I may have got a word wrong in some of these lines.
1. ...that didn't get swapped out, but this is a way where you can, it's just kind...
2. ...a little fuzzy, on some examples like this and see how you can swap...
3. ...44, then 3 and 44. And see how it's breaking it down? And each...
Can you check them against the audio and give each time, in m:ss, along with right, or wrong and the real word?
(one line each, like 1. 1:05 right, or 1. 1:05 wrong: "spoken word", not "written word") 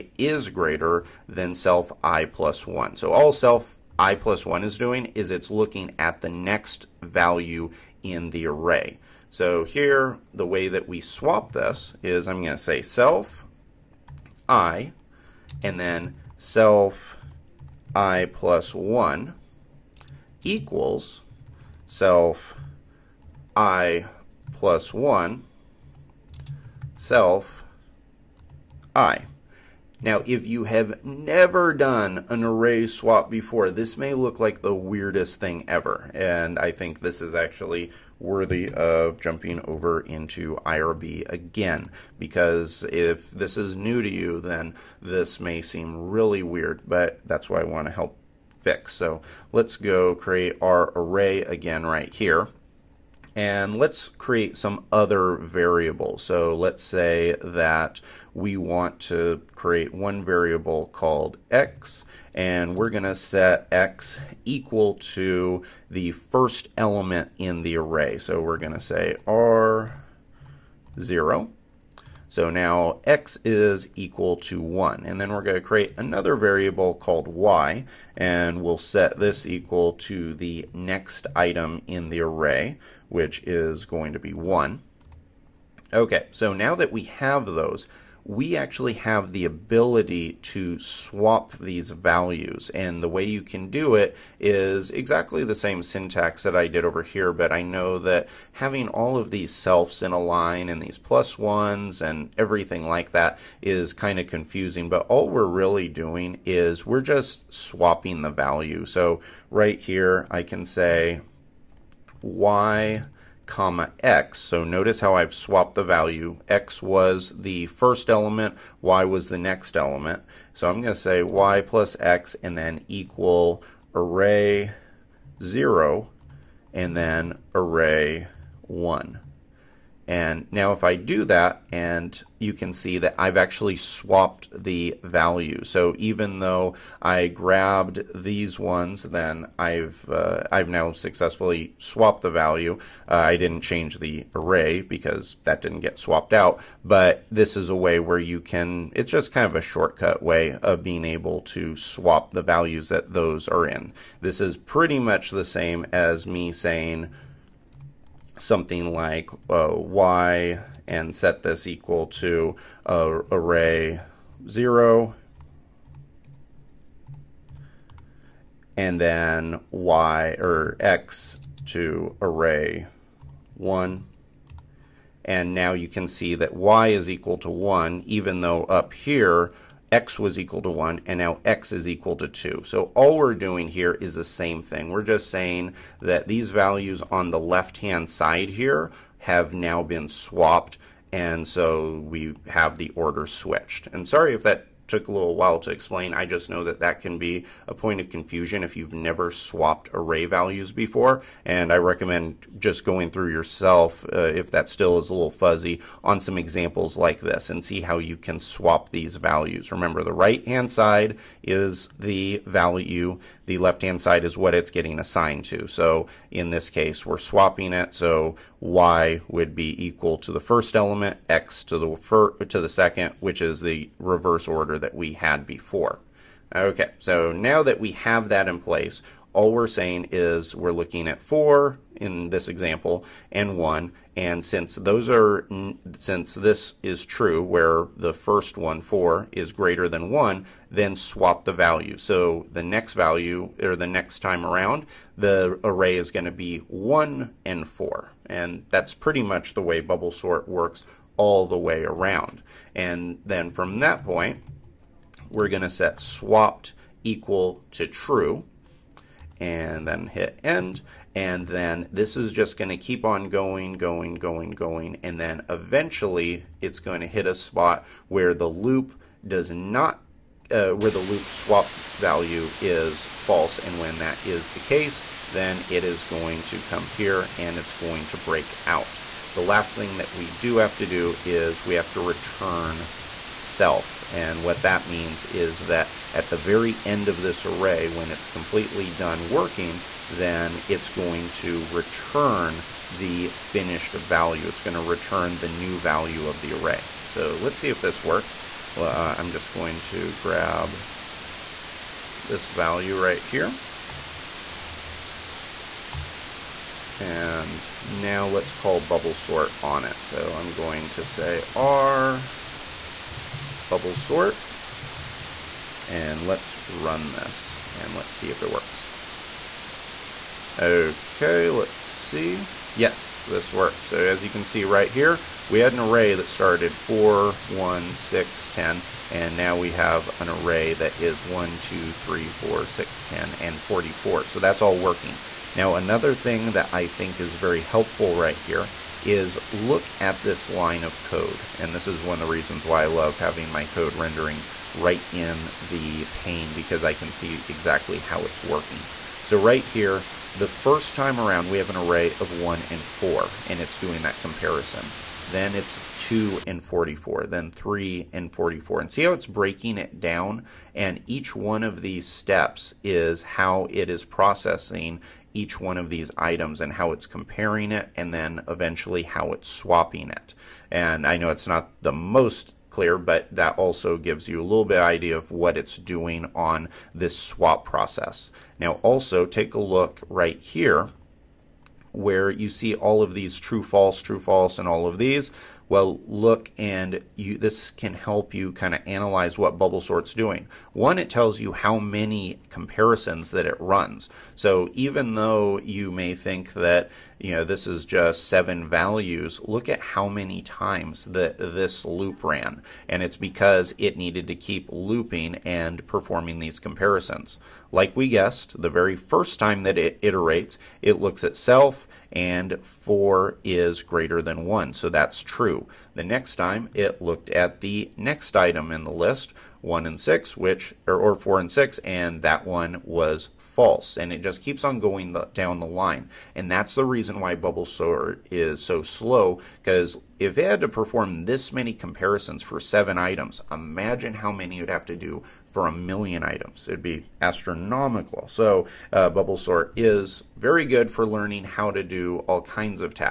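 1. 2:25 right
2. 3:25 right
3. 5:56 right.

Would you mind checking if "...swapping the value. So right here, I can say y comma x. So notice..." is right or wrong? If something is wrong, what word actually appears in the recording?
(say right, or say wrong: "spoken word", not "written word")
right.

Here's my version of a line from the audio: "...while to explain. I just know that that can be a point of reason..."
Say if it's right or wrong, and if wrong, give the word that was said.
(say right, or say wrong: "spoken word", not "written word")
wrong: "confusion", not "reason".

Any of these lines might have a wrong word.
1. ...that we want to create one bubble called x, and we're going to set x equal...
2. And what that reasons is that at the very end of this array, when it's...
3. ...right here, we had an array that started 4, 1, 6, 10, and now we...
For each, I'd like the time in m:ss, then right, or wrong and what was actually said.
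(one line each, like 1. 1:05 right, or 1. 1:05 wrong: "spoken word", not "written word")
1. 0:57 wrong: "variable", not "bubble"
2. 4:44 wrong: "means", not "reasons"
3. 5:24 right.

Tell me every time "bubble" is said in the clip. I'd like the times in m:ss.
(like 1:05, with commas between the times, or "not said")
4:09, 5:08, 5:13, 6:29, 7:07, 7:19.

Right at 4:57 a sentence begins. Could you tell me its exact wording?
So let's see if this works.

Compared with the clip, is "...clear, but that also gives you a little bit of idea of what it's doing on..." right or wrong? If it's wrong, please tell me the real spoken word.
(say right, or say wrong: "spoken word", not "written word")
right.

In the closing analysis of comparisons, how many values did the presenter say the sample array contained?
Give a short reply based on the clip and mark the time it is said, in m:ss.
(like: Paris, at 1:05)
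7, at 6:38.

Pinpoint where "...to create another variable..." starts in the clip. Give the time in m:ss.
1:15.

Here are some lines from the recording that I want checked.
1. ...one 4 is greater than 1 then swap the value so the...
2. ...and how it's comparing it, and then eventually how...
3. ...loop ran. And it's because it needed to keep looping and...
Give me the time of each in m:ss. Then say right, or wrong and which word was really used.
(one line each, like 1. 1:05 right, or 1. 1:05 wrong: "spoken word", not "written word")
1. 3:58 right
2. 6:06 right
3. 6:41 right.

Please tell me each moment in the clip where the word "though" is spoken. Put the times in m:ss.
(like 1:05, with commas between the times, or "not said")
2:16, 2:58, 6:35.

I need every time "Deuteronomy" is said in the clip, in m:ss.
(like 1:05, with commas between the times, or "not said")
not said.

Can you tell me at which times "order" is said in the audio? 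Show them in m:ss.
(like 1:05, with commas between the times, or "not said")
3:12, 3:44.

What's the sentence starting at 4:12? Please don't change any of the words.
And then from that point, we're going to set swapped equal to true and then hit end.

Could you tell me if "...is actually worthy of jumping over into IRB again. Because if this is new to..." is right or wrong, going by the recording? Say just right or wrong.
right.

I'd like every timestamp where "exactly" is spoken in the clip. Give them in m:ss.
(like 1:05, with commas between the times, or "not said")
1:34, 5:47.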